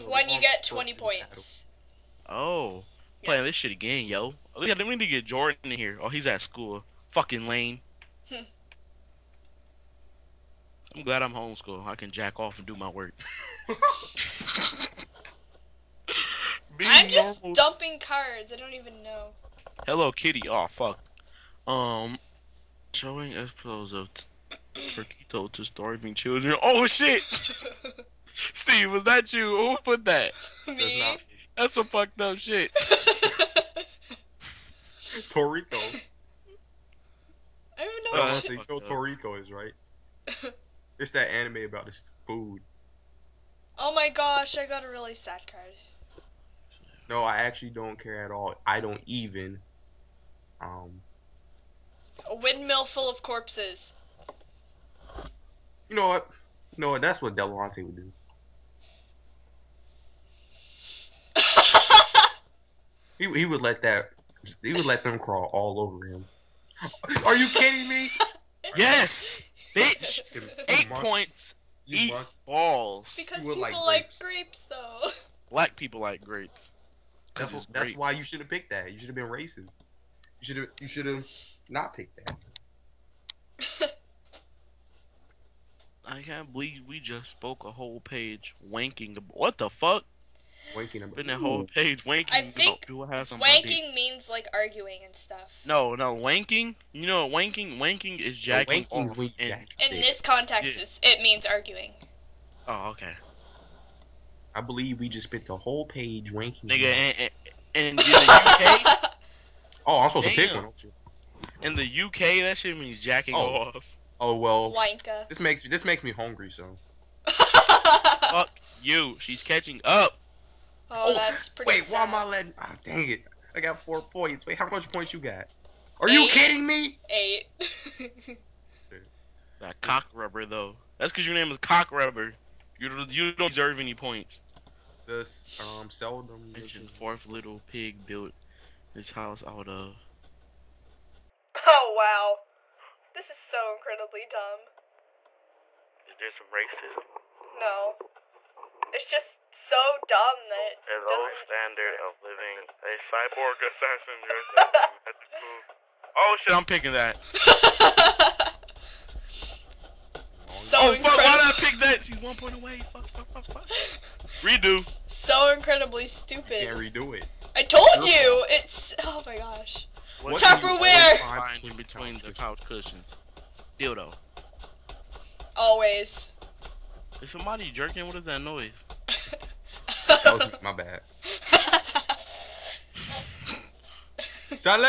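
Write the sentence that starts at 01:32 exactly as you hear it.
I think you wanking means like arguing and stuff.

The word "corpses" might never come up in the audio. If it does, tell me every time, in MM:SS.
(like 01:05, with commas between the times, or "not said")
00:53.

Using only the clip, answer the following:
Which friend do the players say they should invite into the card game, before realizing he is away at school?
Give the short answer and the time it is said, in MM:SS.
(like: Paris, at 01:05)
Jordan, at 00:05.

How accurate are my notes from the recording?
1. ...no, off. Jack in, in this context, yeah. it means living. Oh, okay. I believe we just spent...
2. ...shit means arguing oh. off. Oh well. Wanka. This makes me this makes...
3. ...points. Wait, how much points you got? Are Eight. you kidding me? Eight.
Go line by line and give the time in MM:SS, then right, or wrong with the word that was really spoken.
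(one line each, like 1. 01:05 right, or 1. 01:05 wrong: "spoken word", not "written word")
1. 01:38 wrong: "arguing", not "living"
2. 01:52 wrong: "jacking", not "arguing"
3. 02:04 right.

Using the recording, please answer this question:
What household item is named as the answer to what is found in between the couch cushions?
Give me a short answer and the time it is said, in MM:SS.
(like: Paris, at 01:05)
Tupperware, at 02:50.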